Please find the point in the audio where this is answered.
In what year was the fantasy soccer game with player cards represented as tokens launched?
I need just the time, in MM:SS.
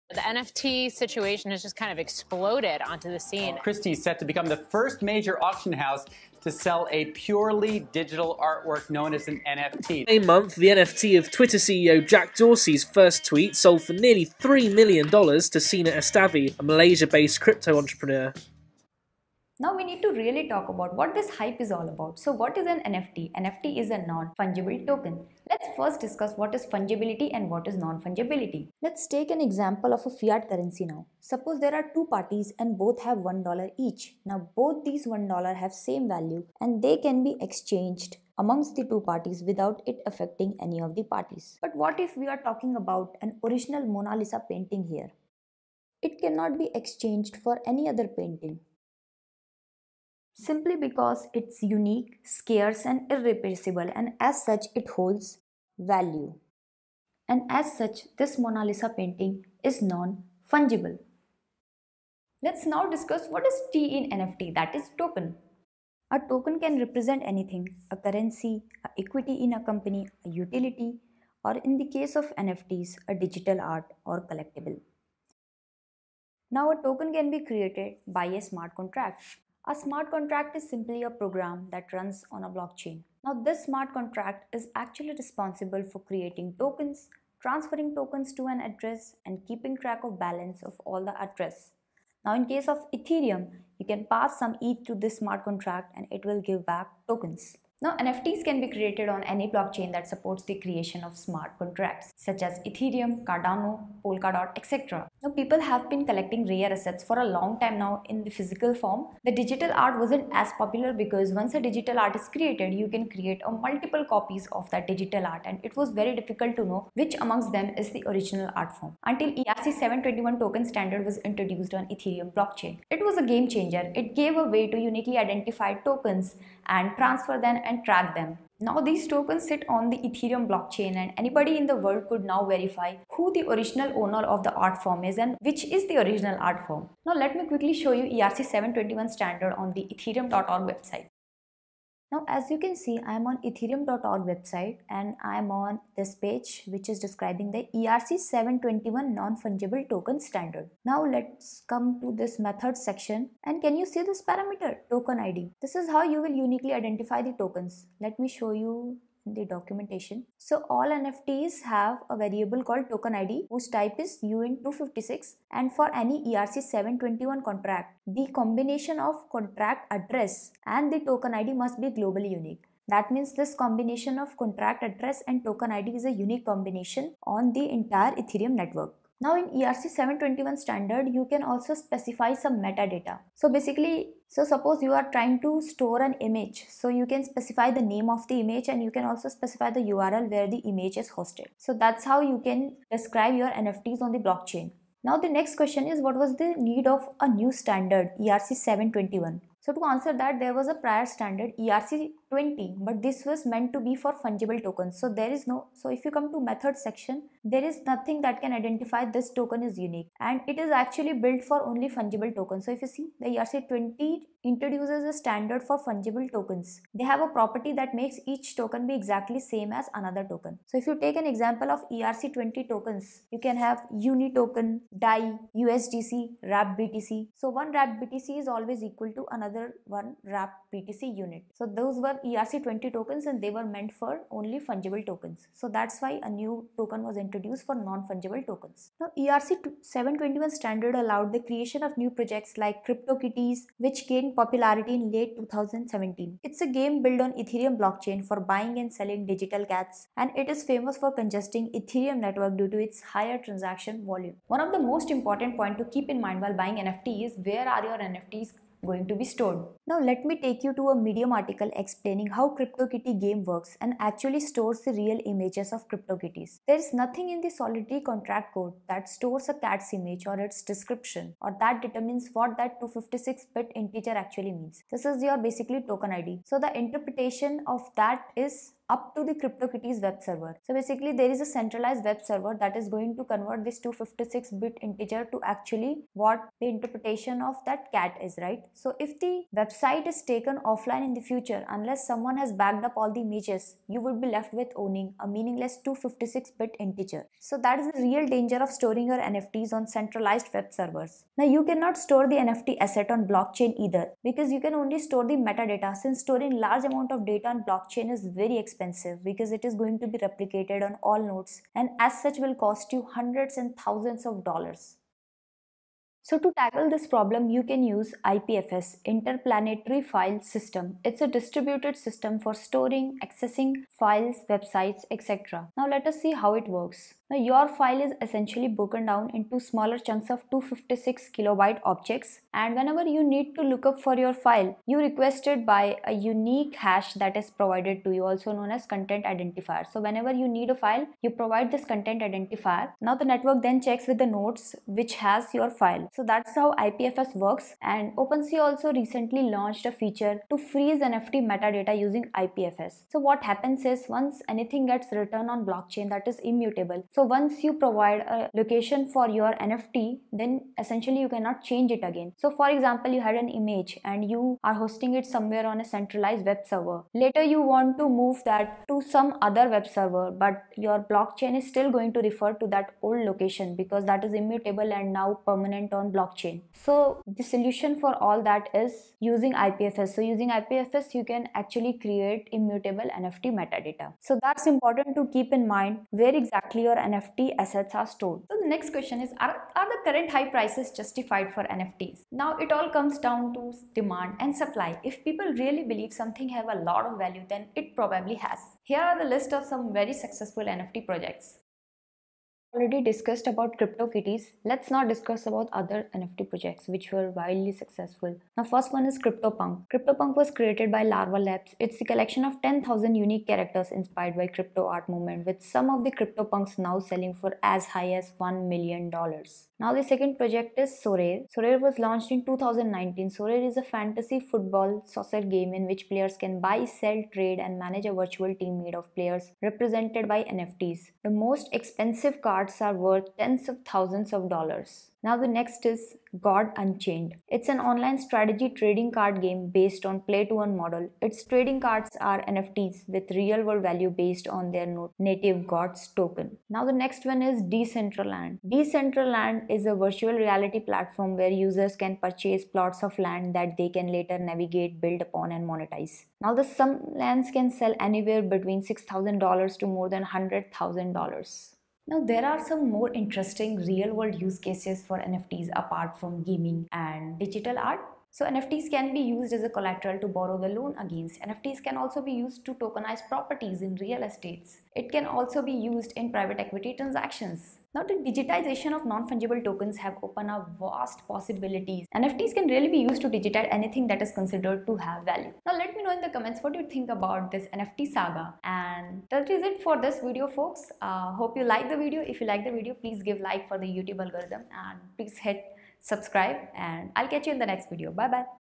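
07:02.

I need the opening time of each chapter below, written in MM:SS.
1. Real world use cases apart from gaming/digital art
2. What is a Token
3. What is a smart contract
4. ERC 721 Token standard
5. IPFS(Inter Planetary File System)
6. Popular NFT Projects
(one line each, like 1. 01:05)
1. 07:48
2. 01:02
3. 01:15
4. 02:21
5. 05:15
6. 06:41.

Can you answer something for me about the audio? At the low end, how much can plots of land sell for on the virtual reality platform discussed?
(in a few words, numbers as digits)
$6,000.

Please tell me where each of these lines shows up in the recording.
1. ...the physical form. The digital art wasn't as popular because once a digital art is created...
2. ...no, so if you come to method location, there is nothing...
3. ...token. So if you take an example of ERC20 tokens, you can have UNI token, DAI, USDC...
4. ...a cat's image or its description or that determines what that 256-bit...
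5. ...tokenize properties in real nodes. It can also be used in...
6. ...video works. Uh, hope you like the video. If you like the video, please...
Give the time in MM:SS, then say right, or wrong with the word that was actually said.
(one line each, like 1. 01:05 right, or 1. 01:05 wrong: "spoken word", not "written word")
1. 01:48 right
2. 03:25 wrong: "section", not "location"
3. 03:40 right
4. 04:29 right
5. 07:52 wrong: "estates", not "nodes"
6. 08:10 wrong: "folks", not "works".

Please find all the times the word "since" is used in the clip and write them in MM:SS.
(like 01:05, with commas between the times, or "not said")
05:05.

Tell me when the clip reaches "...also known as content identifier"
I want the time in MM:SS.
05:38.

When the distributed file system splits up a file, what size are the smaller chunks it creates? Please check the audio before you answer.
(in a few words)
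256 kilobyte.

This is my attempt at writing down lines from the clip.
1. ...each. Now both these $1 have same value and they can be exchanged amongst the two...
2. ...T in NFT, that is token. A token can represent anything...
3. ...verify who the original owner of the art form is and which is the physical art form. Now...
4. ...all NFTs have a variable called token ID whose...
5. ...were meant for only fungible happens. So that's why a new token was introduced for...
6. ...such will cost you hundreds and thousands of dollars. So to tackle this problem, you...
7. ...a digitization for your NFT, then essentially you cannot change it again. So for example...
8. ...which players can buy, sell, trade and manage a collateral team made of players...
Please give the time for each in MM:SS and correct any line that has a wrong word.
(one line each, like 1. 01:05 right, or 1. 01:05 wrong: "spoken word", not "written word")
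1. 00:33 right
2. 01:03 right
3. 02:12 wrong: "original", not "physical"
4. 02:40 right
5. 03:53 wrong: "tokens", not "happens"
6. 05:12 right
7. 05:58 wrong: "location", not "digitization"
8. 07:05 wrong: "virtual", not "collateral".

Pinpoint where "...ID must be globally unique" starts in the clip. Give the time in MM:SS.
02:51.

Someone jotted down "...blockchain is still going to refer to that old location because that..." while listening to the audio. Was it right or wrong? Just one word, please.
right.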